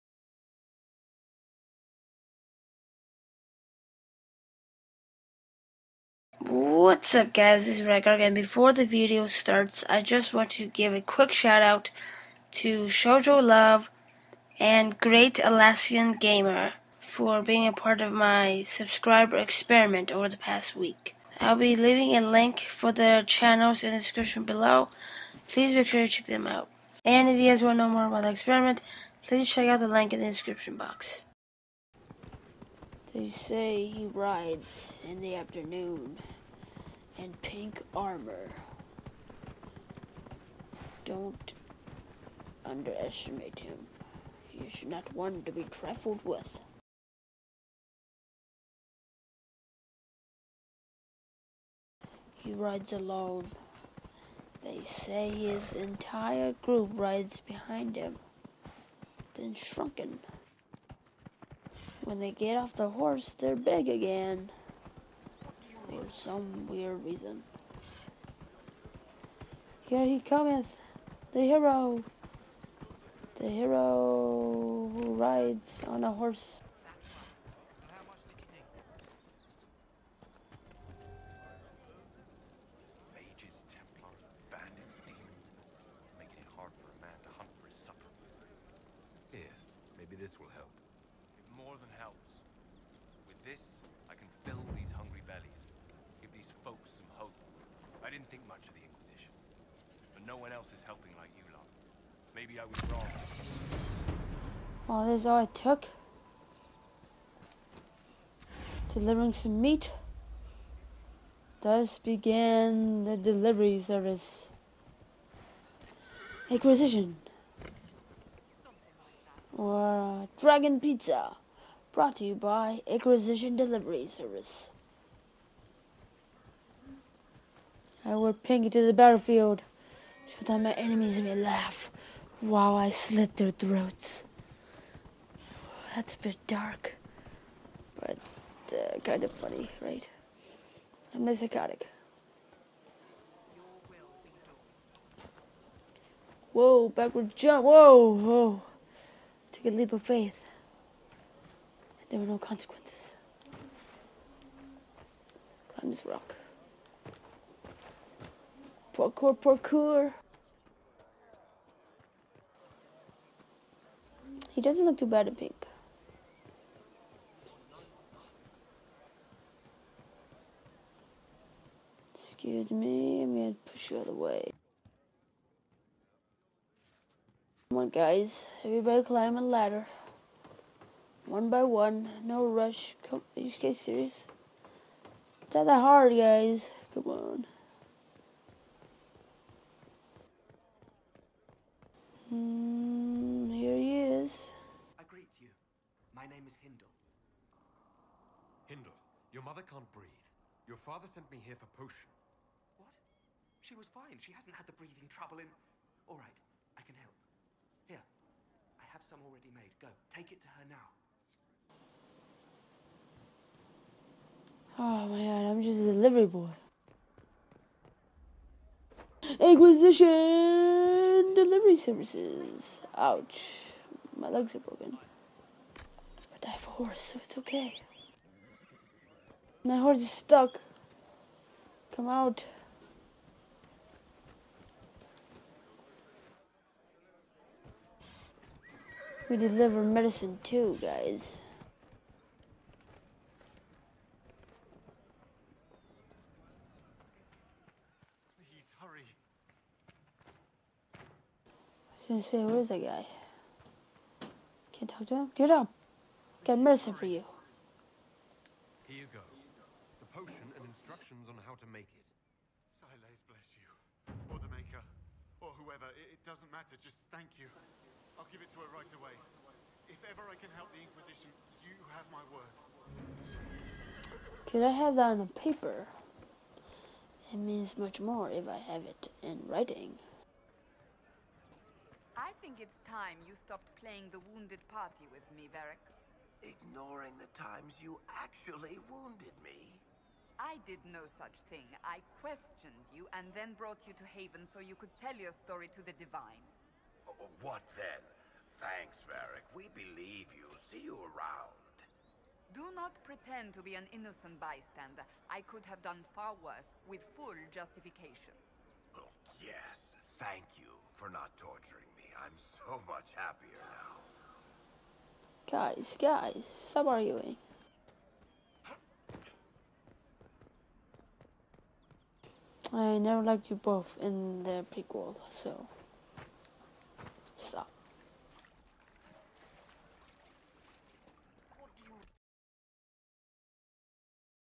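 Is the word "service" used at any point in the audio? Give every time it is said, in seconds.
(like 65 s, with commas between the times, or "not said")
113 s, 124 s, 221 s.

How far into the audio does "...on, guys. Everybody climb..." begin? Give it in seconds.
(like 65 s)
177 s.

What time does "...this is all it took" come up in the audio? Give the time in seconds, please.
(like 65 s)
105 s.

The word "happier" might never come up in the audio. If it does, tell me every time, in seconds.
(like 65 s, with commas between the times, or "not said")
313 s.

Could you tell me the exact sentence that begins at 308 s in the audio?
Oh, yes, thank you for not torturing me.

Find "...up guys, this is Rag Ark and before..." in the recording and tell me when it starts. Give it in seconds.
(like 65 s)
7 s.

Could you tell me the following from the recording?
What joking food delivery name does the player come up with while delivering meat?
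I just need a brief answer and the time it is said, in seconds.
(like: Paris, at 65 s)
Dragon Pizza, at 120 s.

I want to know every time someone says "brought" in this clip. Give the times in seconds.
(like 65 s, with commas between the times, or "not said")
121 s, 293 s.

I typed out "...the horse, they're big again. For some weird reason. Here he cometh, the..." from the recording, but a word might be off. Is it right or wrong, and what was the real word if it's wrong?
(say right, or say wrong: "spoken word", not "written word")
right.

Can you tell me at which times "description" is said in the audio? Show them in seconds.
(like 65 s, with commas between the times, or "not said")
23 s, 30 s.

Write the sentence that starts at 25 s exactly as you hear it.
Please make sure to check them out.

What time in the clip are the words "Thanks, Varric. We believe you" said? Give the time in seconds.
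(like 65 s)
298 s.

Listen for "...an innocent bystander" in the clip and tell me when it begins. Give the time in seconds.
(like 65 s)
303 s.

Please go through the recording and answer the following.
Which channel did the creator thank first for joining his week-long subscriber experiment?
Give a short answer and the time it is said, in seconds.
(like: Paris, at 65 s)
Shojolove, at 12 s.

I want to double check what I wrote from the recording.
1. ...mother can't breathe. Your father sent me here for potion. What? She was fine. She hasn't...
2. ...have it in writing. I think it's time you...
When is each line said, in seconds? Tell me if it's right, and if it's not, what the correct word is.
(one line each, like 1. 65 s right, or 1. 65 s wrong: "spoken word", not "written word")
1. 199 s right
2. 278 s right.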